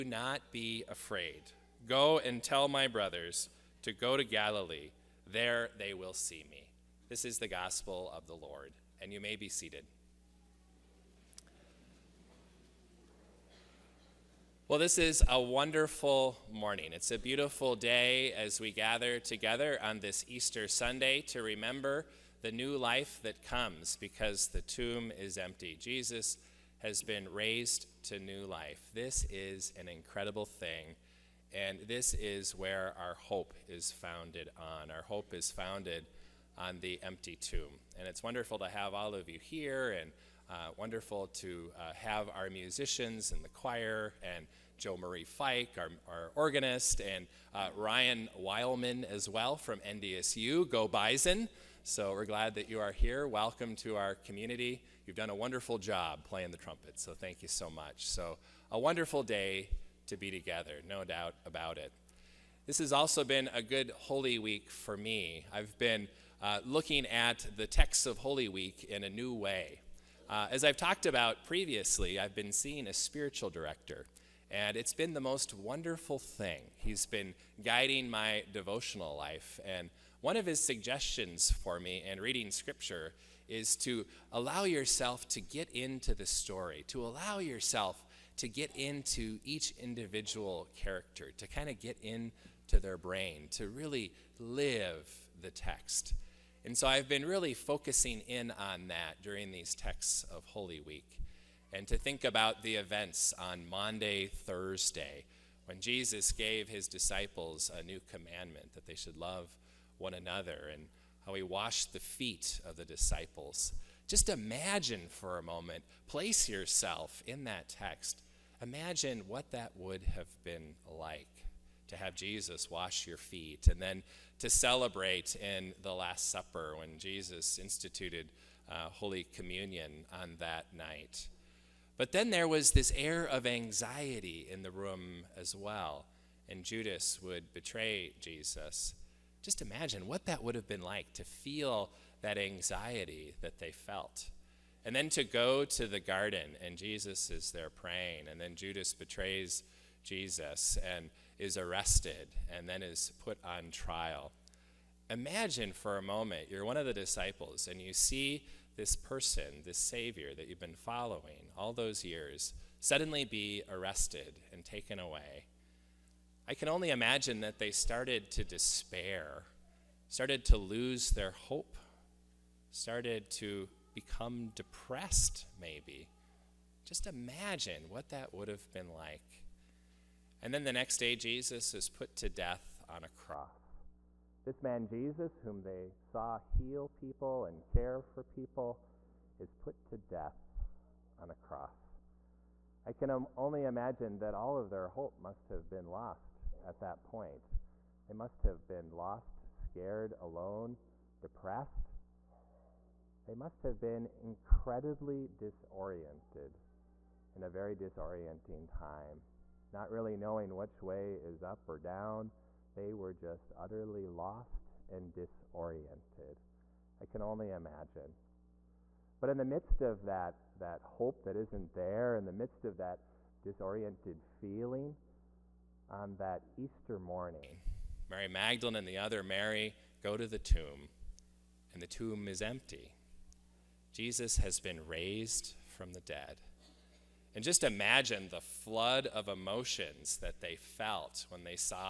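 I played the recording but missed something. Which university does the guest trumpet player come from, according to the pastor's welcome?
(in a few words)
NDSU.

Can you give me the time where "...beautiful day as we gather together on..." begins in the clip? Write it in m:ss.
0:17.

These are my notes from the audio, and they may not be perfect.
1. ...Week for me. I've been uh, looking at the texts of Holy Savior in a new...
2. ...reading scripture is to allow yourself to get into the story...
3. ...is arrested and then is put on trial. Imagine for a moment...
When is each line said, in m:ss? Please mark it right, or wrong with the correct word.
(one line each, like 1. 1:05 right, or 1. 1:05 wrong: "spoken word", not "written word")
1. 1:04 wrong: "Week", not "Savior"
2. 1:22 right
3. 2:31 right.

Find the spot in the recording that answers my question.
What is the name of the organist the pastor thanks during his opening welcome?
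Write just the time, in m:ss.
0:44.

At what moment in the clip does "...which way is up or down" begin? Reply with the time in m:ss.
3:30.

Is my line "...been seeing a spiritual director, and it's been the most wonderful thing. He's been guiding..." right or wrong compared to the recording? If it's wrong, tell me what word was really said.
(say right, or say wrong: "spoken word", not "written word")
right.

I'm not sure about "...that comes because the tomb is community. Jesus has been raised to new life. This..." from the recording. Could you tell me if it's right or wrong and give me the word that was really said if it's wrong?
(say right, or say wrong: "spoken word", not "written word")
wrong: "empty", not "community".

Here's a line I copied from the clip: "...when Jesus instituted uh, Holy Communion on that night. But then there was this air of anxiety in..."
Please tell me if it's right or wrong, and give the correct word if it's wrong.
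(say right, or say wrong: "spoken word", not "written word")
right.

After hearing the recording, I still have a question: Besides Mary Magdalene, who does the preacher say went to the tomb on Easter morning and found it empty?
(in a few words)
The other Mary.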